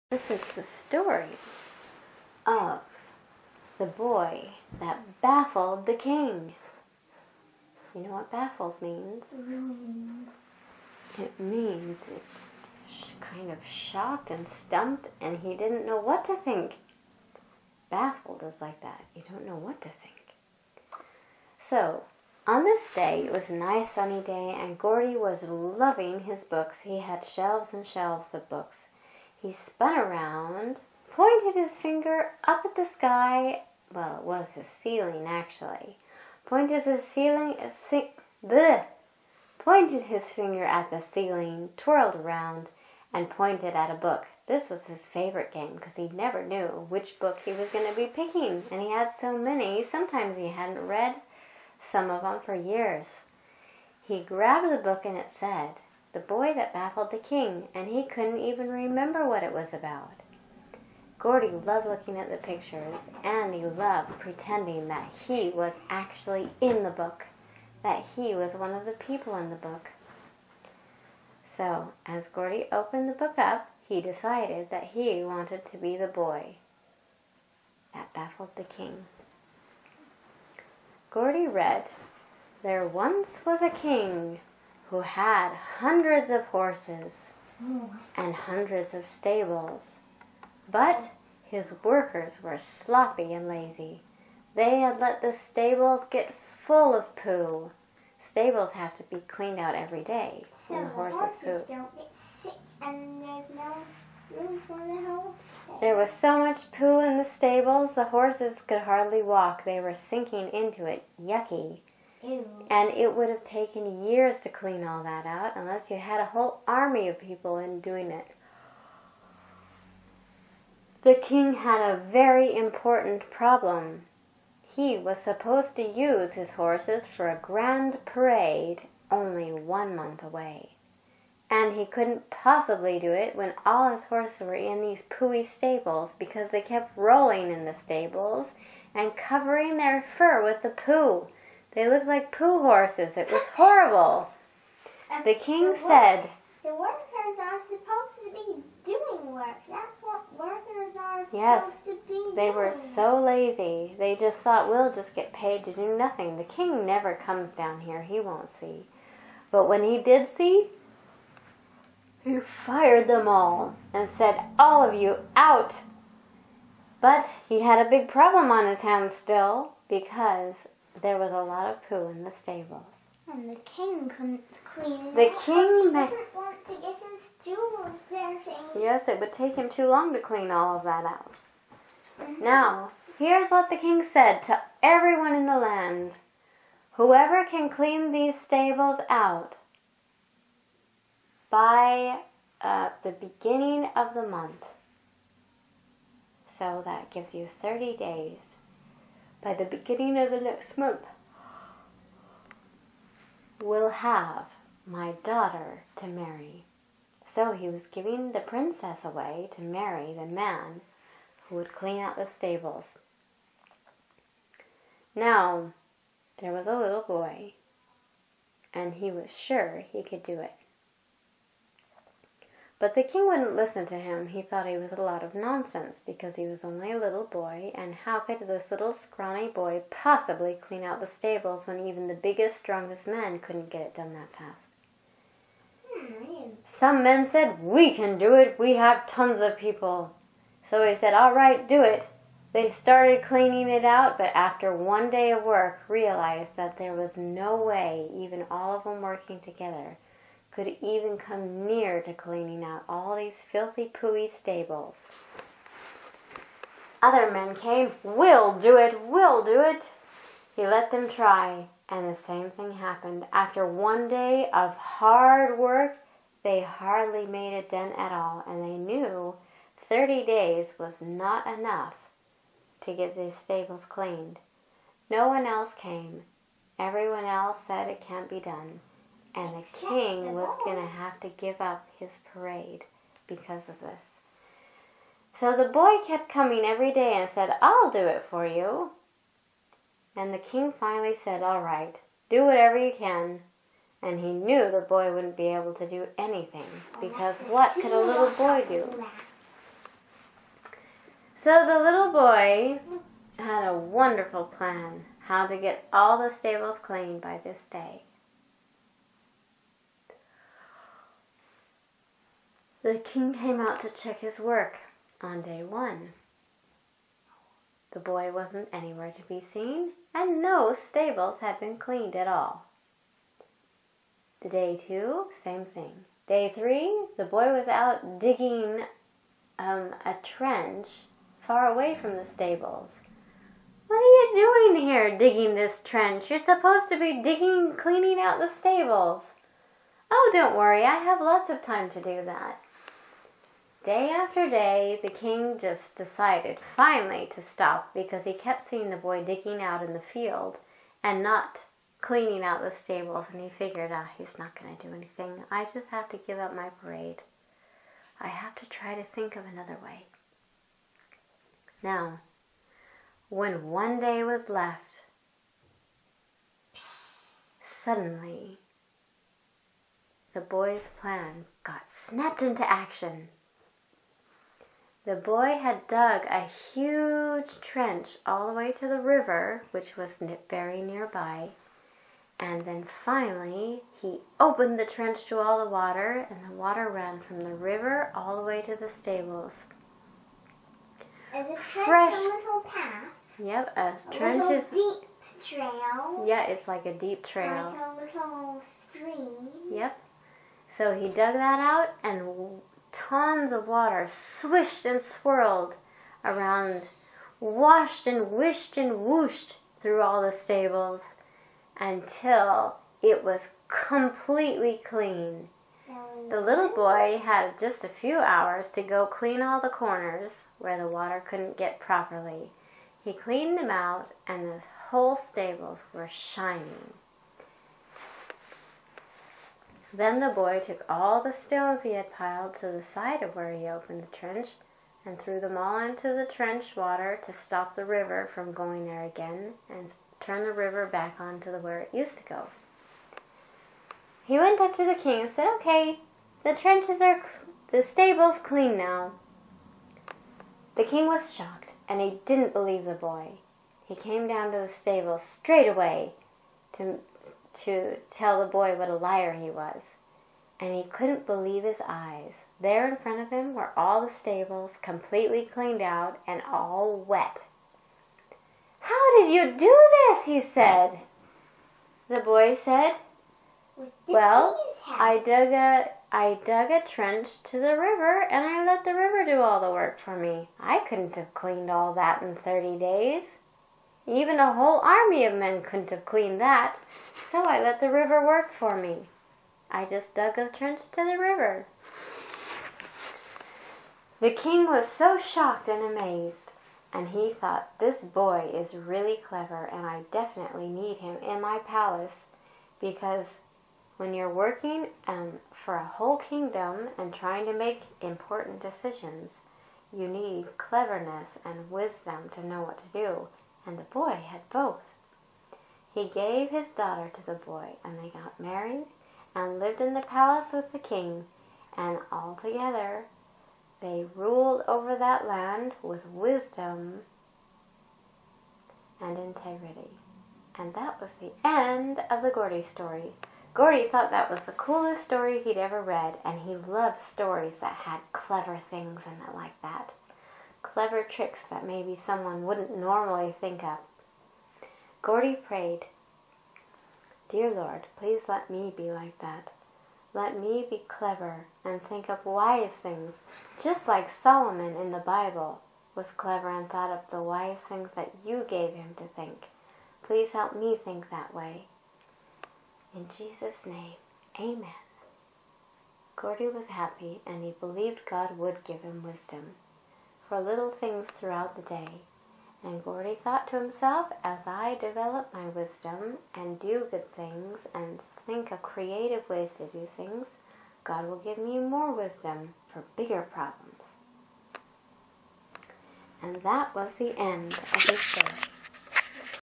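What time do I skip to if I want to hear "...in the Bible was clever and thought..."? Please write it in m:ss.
9:14.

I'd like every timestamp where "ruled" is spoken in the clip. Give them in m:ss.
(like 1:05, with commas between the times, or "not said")
8:44.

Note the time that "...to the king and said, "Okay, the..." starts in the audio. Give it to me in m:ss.
7:24.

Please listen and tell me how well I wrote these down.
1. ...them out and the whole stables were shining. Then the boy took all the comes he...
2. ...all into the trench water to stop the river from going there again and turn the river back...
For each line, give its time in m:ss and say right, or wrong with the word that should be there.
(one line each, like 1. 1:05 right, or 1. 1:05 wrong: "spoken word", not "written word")
1. 7:03 wrong: "stones", not "comes"
2. 7:15 right.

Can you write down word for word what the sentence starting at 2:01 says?
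The king had a very important problem.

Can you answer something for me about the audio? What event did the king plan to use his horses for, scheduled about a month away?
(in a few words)
A grand parade.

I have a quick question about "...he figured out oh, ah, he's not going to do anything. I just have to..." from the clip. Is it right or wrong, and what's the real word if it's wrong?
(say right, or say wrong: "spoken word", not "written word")
right.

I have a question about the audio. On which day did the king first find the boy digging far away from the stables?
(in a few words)
Day three.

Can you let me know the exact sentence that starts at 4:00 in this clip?
So he said, All right, do it.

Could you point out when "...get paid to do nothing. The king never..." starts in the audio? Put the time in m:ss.
2:35.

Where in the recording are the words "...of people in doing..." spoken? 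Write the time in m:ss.
1:57.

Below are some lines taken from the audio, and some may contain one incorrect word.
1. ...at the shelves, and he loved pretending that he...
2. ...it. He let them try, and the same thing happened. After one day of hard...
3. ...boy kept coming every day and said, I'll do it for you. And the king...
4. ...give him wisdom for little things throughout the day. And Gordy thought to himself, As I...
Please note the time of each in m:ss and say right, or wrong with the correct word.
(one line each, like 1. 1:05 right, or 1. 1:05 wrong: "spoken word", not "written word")
1. 1:02 wrong: "pictures", not "shelves"
2. 4:19 right
3. 4:45 right
4. 9:28 right.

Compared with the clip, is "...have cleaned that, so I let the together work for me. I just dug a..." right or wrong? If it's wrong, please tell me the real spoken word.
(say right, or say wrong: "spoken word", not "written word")
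wrong: "river", not "together".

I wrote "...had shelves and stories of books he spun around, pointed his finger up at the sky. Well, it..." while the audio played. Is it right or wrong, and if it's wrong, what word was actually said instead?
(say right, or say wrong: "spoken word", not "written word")
wrong: "shelves", not "stories".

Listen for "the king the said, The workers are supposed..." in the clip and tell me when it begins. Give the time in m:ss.
2:25.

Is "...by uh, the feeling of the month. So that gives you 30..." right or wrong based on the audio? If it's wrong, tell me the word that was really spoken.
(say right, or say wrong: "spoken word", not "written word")
wrong: "beginning", not "feeling".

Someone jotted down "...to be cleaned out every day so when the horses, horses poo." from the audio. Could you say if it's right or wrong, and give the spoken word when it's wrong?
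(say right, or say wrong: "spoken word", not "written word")
right.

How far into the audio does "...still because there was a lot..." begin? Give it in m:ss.
2:49.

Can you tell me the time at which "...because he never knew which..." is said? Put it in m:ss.
0:45.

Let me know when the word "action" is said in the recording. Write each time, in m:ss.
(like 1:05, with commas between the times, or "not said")
6:12.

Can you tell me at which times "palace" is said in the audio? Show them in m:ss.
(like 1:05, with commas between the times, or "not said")
8:21, 8:40.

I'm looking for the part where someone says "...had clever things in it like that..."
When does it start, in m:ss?
8:57.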